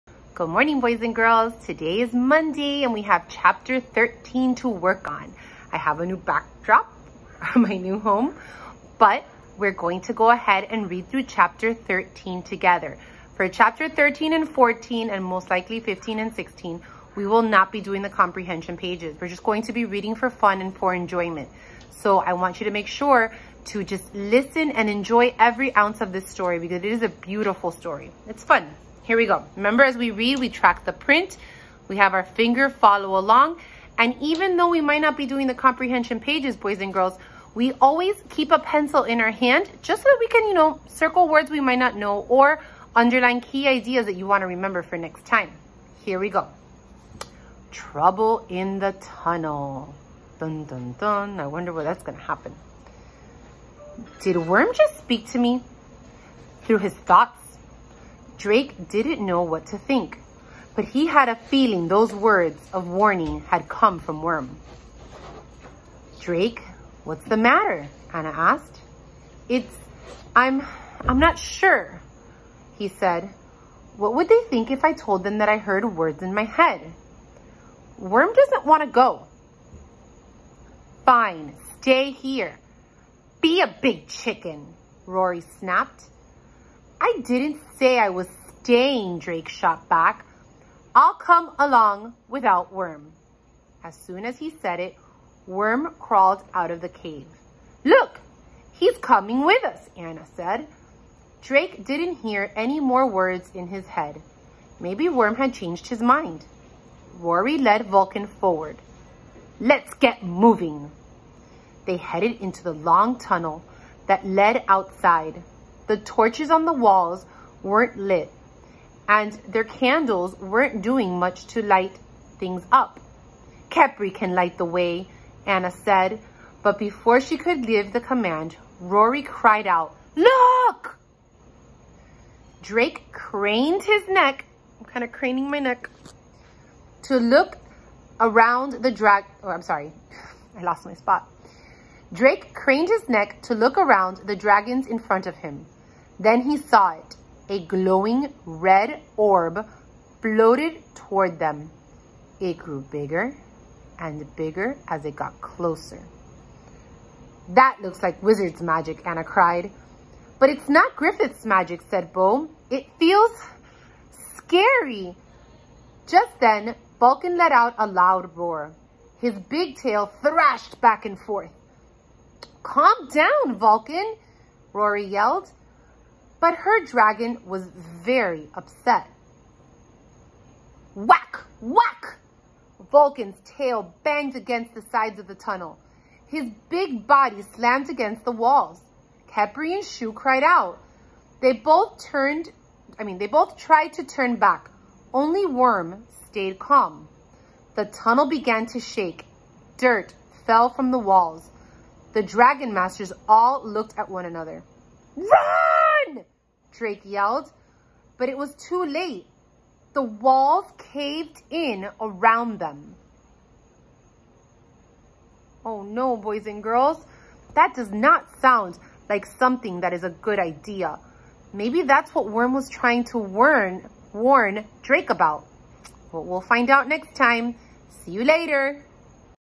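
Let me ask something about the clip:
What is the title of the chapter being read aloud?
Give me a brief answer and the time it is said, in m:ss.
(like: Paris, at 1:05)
Trouble in the Tunnel, at 0:47.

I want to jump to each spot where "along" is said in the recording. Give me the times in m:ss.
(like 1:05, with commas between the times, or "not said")
0:33, 1:31.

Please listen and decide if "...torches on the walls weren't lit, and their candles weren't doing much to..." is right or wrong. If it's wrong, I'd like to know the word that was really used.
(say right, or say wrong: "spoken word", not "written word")
right.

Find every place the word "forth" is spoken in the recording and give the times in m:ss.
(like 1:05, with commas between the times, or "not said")
2:51.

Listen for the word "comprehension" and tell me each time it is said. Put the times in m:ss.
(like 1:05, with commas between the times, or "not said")
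0:18, 0:35.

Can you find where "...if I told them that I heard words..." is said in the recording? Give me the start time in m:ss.
1:14.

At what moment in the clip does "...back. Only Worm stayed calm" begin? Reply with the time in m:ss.
3:14.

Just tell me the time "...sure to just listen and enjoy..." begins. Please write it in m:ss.
0:22.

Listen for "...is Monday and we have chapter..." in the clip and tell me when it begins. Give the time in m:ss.
0:02.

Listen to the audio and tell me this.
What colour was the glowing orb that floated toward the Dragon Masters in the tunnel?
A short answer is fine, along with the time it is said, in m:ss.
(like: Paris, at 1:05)
Red, at 2:28.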